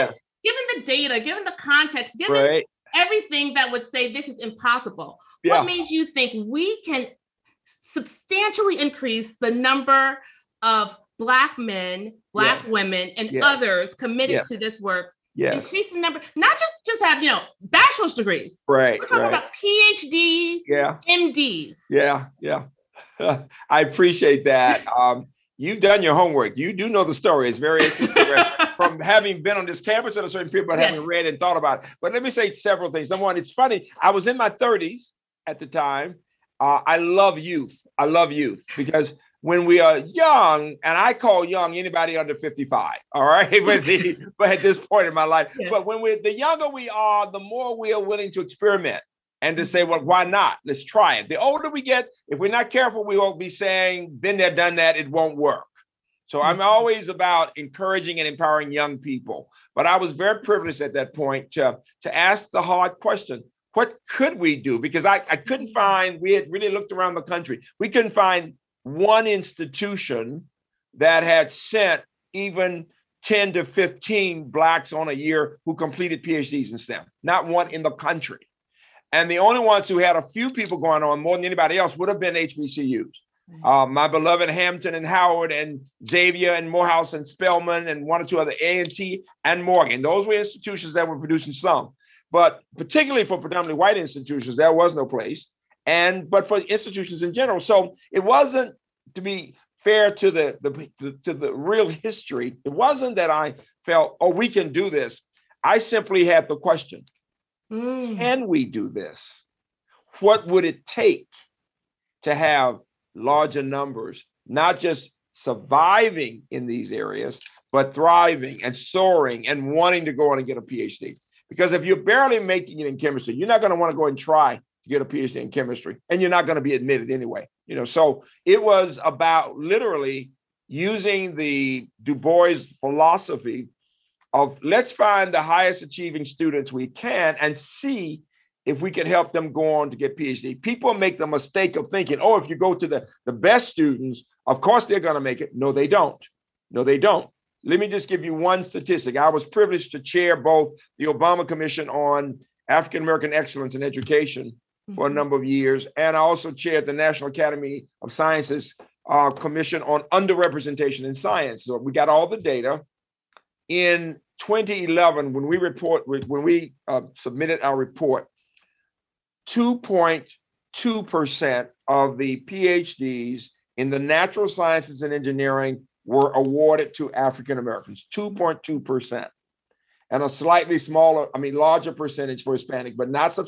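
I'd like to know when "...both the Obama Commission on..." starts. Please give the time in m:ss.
2:30.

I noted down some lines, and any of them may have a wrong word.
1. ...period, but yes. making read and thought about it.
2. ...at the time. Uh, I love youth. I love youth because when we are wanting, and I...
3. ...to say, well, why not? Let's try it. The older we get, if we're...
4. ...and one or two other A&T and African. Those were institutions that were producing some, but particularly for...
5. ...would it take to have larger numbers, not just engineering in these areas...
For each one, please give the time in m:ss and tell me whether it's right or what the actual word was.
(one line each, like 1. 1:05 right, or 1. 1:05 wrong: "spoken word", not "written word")
1. 0:30 wrong: "having", not "making"
2. 0:35 wrong: "young", not "wanting"
3. 0:49 right
4. 1:27 wrong: "Morgan", not "African"
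5. 1:50 wrong: "surviving", not "engineering".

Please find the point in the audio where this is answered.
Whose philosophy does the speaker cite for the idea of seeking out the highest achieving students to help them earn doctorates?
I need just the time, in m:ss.
2:12.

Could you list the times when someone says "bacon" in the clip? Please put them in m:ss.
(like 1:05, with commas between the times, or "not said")
not said.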